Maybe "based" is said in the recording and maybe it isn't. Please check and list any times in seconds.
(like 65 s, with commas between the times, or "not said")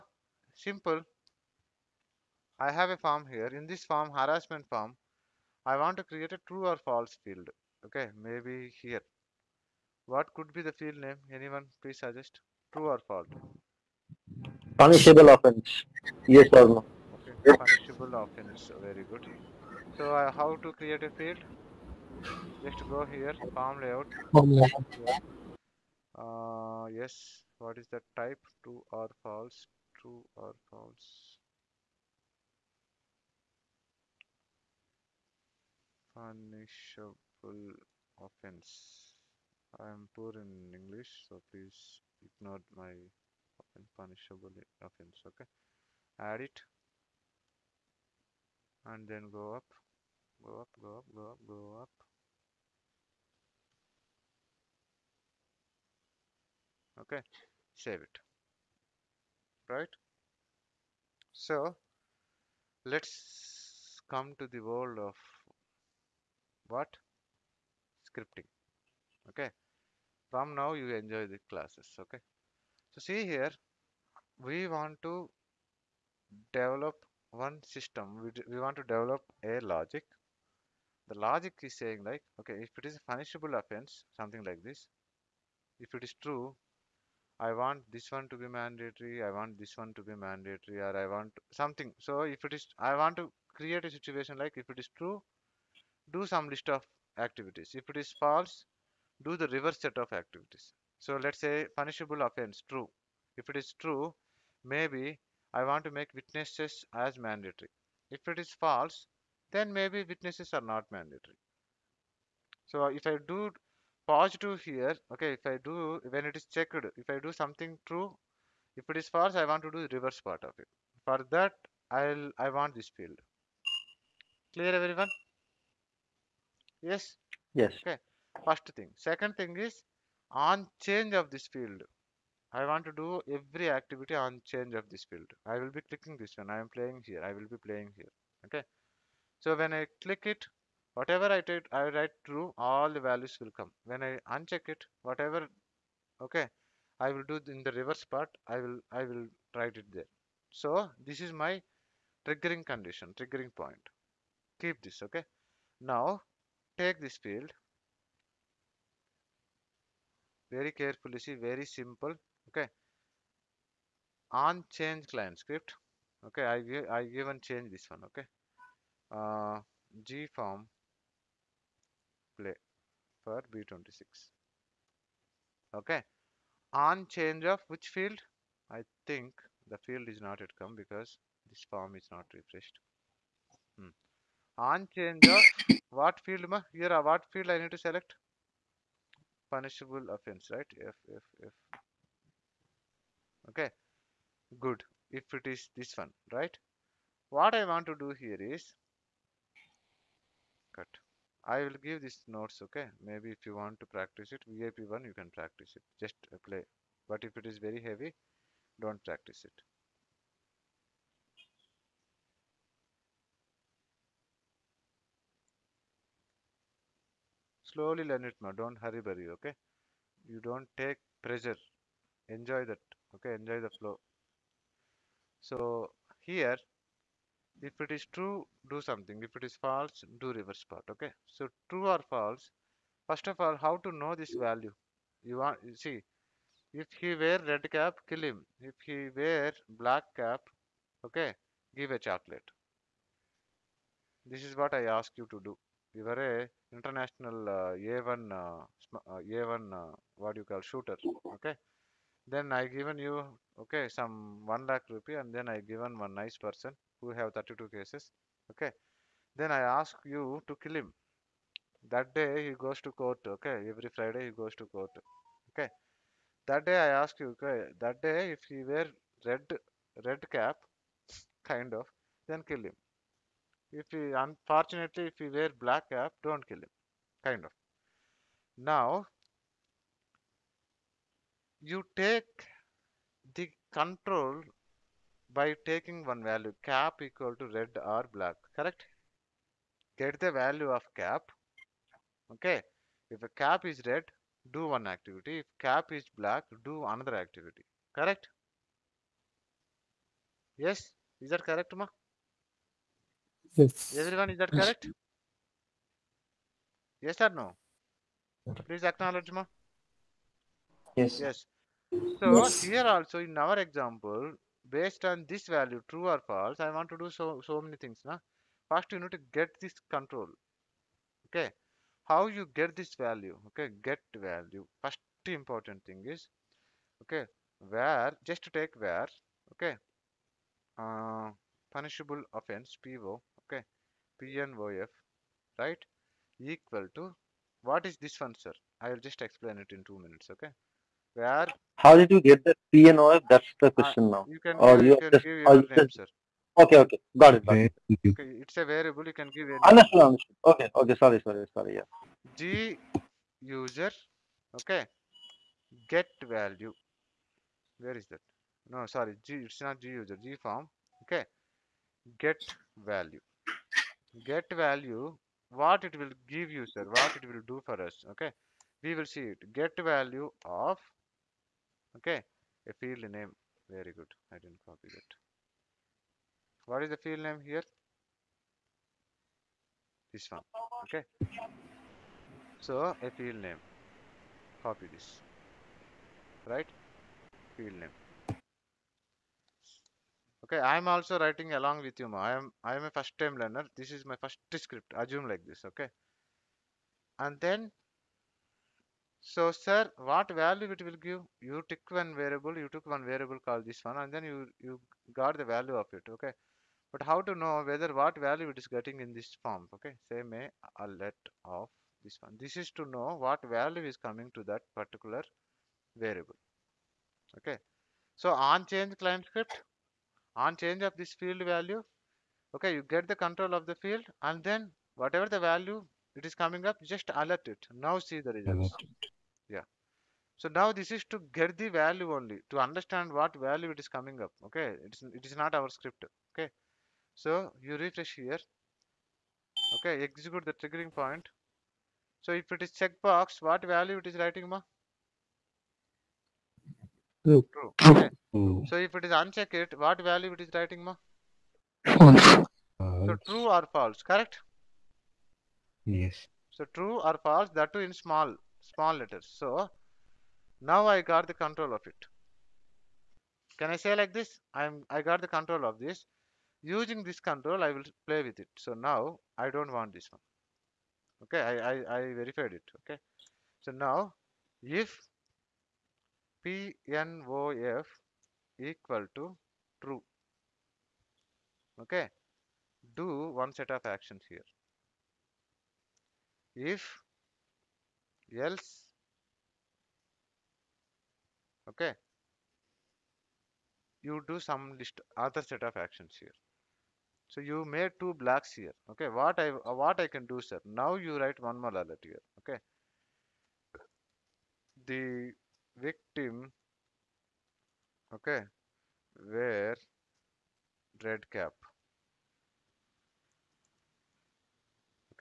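314 s.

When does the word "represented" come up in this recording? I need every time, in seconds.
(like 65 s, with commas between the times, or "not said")
not said.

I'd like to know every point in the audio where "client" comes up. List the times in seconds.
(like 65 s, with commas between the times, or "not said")
165 s, 418 s.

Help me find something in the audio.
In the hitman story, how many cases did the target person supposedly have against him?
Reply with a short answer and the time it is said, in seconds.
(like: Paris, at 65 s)
32, at 257 s.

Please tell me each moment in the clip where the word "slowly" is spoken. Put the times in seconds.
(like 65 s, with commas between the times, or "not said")
217 s.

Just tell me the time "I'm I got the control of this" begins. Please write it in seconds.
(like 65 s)
464 s.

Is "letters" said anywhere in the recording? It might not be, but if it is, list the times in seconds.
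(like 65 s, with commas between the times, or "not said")
458 s.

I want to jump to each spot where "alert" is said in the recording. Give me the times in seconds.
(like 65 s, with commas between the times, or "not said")
410 s, 427 s, 501 s.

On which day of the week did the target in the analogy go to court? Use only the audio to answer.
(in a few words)
Friday.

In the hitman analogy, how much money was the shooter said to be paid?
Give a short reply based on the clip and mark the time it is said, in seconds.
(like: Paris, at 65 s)
1 lakh rupees, at 254 s.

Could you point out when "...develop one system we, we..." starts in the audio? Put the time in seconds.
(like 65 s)
76 s.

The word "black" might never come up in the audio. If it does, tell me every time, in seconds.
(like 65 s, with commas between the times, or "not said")
239 s, 275 s, 288 s, 296 s.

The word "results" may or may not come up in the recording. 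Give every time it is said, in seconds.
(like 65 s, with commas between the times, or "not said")
428 s.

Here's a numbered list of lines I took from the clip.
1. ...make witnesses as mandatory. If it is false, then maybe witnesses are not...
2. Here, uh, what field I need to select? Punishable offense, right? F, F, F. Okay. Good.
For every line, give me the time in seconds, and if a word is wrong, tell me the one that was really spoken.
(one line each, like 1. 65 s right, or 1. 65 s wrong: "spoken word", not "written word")
1. 105 s right
2. 186 s right.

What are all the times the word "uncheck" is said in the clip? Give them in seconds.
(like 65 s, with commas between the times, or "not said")
144 s, 449 s.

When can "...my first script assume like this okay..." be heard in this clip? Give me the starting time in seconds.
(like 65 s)
394 s.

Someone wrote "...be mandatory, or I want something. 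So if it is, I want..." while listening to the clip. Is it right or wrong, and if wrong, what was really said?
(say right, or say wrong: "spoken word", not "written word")
right.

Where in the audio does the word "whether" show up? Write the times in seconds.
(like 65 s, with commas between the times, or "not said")
407 s.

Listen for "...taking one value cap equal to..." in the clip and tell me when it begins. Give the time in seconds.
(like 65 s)
285 s.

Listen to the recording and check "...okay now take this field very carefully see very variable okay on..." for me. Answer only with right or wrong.
wrong.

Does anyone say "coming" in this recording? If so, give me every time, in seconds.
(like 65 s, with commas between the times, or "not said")
413 s, 426 s, 433 s.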